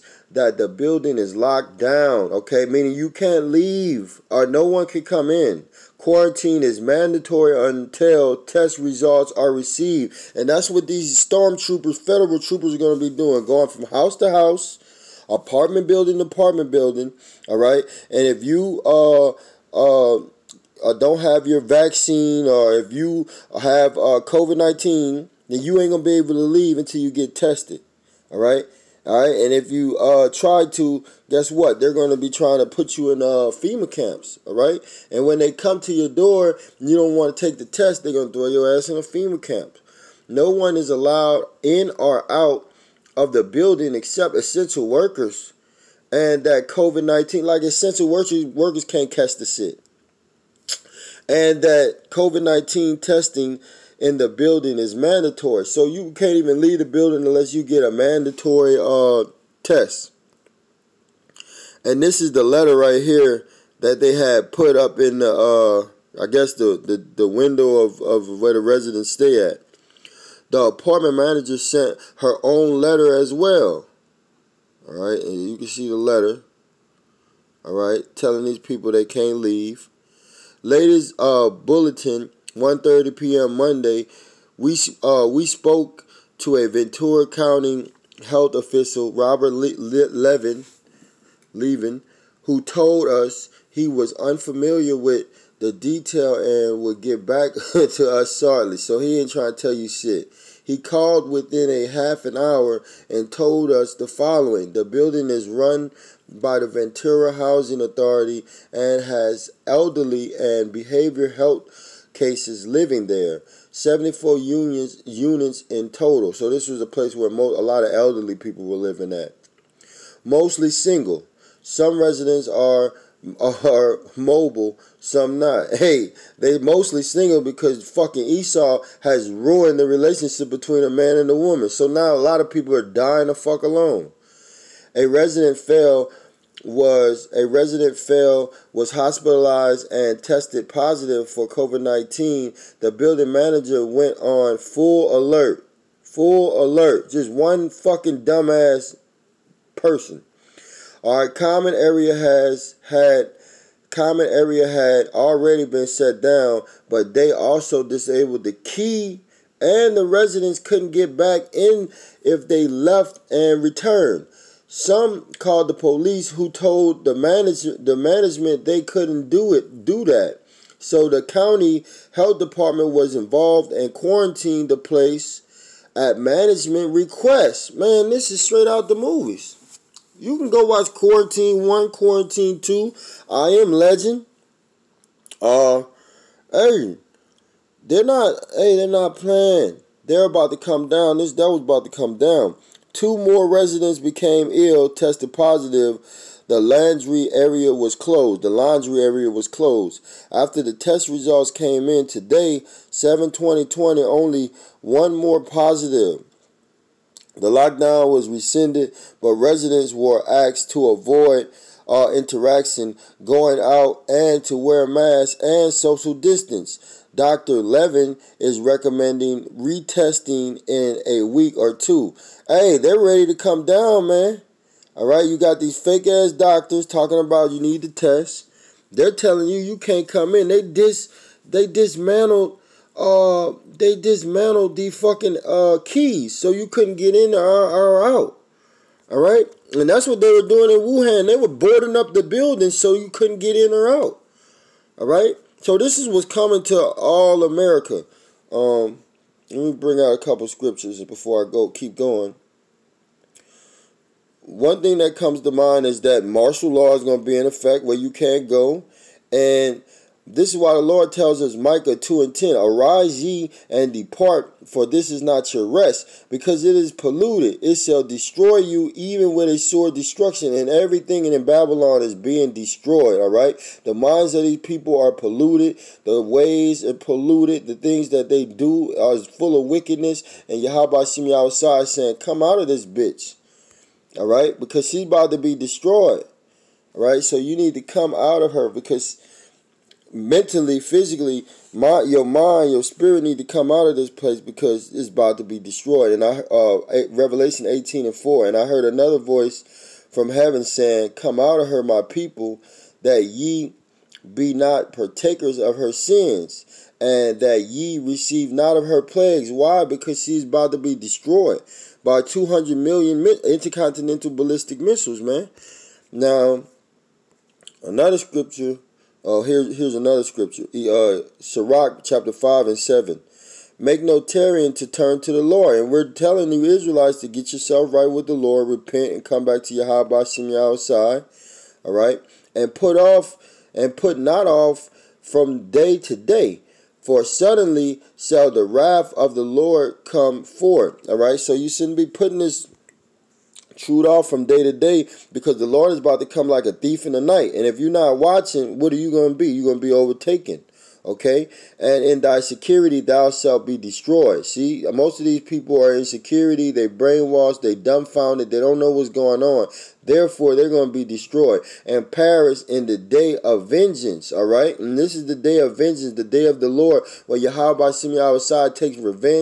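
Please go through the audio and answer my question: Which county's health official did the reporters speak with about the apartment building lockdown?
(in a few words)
Ventura County.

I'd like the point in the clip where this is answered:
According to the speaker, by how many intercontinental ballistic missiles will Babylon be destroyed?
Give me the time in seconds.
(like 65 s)
312 s.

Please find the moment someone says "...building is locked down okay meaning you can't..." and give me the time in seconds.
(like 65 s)
0 s.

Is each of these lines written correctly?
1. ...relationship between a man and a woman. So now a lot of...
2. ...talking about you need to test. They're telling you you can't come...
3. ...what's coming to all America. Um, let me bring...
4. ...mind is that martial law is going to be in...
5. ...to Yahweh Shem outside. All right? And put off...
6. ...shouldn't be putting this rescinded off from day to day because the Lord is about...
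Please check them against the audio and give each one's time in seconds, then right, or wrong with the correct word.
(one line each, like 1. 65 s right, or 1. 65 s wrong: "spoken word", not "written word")
1. 129 s right
2. 226 s right
3. 246 s right
4. 255 s right
5. 329 s right
6. 341 s wrong: "chewed", not "rescinded".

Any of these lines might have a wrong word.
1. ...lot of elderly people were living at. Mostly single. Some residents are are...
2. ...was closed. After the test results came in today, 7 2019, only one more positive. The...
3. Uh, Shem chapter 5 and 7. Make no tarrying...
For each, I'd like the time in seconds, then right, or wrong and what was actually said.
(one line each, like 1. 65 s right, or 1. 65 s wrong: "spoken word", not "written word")
1. 117 s right
2. 199 s wrong: "2020", not "2019"
3. 320 s wrong: "Sirach", not "Shem".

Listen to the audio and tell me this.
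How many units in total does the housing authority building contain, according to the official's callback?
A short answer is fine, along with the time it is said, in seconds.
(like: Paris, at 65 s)
74, at 113 s.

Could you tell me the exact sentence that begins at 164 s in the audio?
Some called the police who told the manage, the management they couldn't do it do that.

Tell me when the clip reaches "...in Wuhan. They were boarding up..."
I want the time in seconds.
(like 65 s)
240 s.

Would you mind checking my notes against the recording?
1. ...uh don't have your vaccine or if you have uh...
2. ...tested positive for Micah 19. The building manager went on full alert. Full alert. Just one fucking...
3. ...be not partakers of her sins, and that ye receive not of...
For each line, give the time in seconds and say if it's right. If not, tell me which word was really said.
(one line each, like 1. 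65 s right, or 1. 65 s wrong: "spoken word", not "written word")
1. 20 s right
2. 140 s wrong: "COVID", not "Micah"
3. 304 s right.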